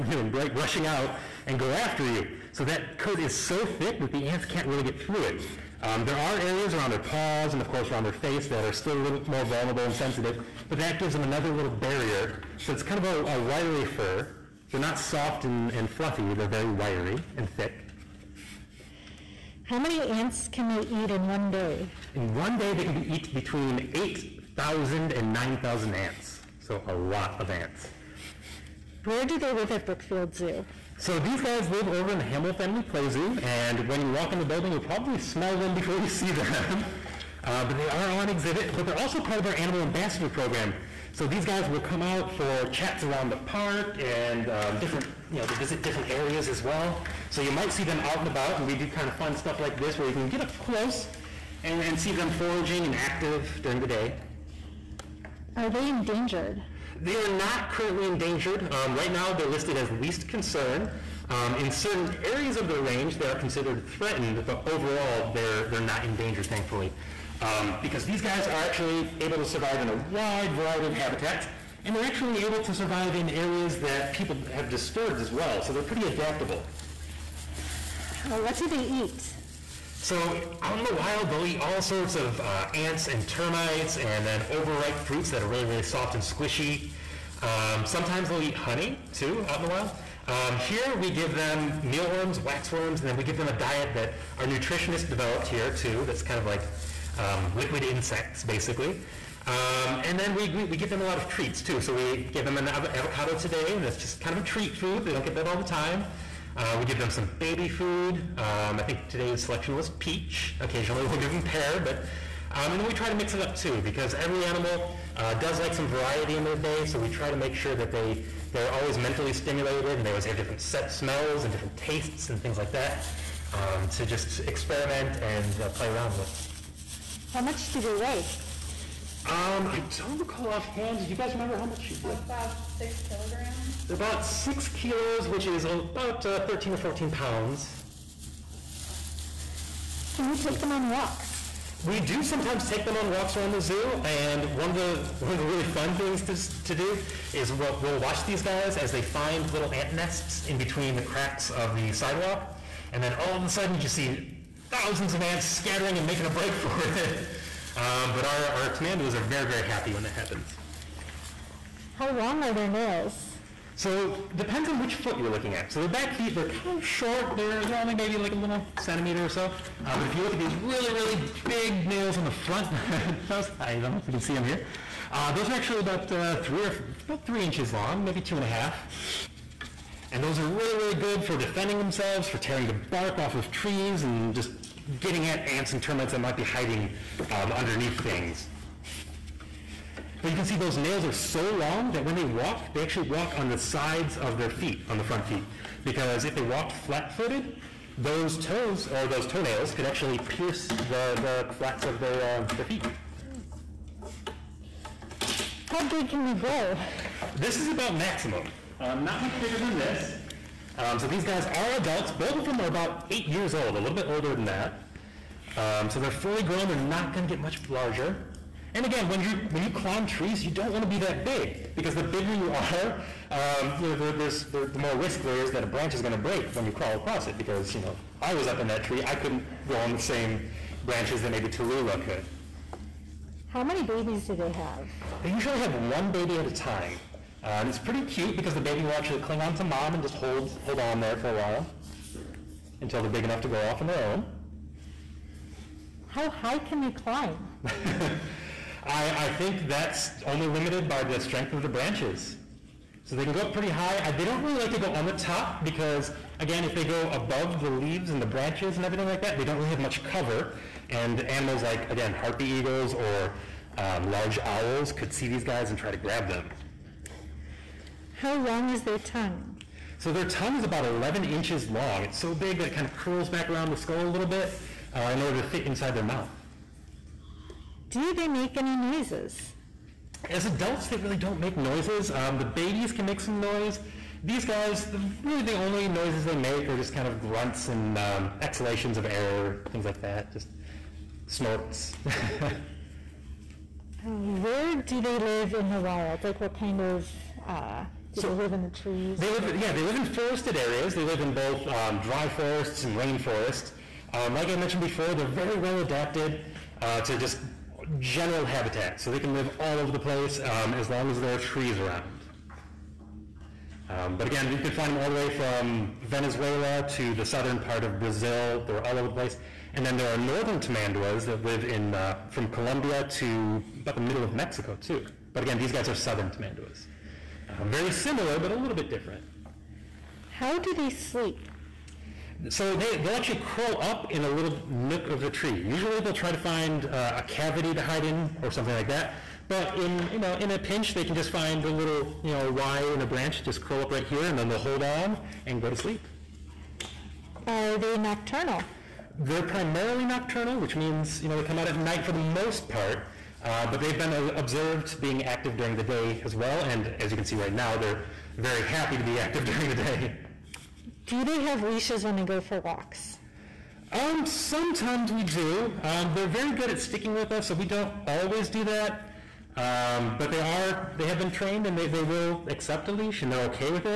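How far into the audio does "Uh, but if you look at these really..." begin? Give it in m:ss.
2:49.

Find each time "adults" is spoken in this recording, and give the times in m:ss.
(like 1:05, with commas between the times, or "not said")
3:31, 4:40.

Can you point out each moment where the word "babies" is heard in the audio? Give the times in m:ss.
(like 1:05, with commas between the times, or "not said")
3:53, 4:42.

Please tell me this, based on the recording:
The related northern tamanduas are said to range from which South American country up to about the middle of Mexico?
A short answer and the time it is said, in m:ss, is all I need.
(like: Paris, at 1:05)
Colombia, at 5:22.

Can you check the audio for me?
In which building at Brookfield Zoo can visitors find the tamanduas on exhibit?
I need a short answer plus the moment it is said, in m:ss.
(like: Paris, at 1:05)
Hamill family play zoo, at 0:32.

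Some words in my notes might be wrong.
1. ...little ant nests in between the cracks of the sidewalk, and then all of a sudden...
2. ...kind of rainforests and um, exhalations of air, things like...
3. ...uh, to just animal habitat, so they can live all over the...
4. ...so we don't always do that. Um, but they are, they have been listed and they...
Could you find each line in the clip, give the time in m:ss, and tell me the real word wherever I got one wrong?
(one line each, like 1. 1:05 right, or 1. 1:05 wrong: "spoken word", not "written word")
1. 2:29 right
2. 4:46 wrong: "grunts", not "rainforests"
3. 5:06 wrong: "general", not "animal"
4. 6:07 wrong: "trained", not "listed".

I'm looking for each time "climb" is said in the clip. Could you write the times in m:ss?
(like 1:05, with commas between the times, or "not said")
3:39, 4:06.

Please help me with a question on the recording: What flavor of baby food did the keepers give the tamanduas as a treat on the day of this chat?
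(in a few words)
Peach.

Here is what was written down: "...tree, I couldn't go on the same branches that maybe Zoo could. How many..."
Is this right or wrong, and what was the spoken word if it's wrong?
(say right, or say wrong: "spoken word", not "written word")
wrong: "Tallulah", not "Zoo".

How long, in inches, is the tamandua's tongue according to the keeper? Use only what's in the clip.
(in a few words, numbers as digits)
11 inches.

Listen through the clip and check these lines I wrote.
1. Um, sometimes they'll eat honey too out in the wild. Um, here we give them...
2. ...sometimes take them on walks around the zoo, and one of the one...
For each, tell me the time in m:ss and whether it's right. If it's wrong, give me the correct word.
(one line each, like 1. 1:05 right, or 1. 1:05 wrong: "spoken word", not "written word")
1. 1:27 right
2. 2:22 right.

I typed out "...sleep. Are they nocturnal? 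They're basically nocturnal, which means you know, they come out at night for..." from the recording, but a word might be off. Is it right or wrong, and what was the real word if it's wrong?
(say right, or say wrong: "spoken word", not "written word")
wrong: "primarily", not "basically".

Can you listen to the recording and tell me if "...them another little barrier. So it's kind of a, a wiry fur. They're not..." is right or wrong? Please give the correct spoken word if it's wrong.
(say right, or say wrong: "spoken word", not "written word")
right.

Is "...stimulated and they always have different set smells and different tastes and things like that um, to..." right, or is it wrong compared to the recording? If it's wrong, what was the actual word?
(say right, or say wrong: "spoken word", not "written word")
right.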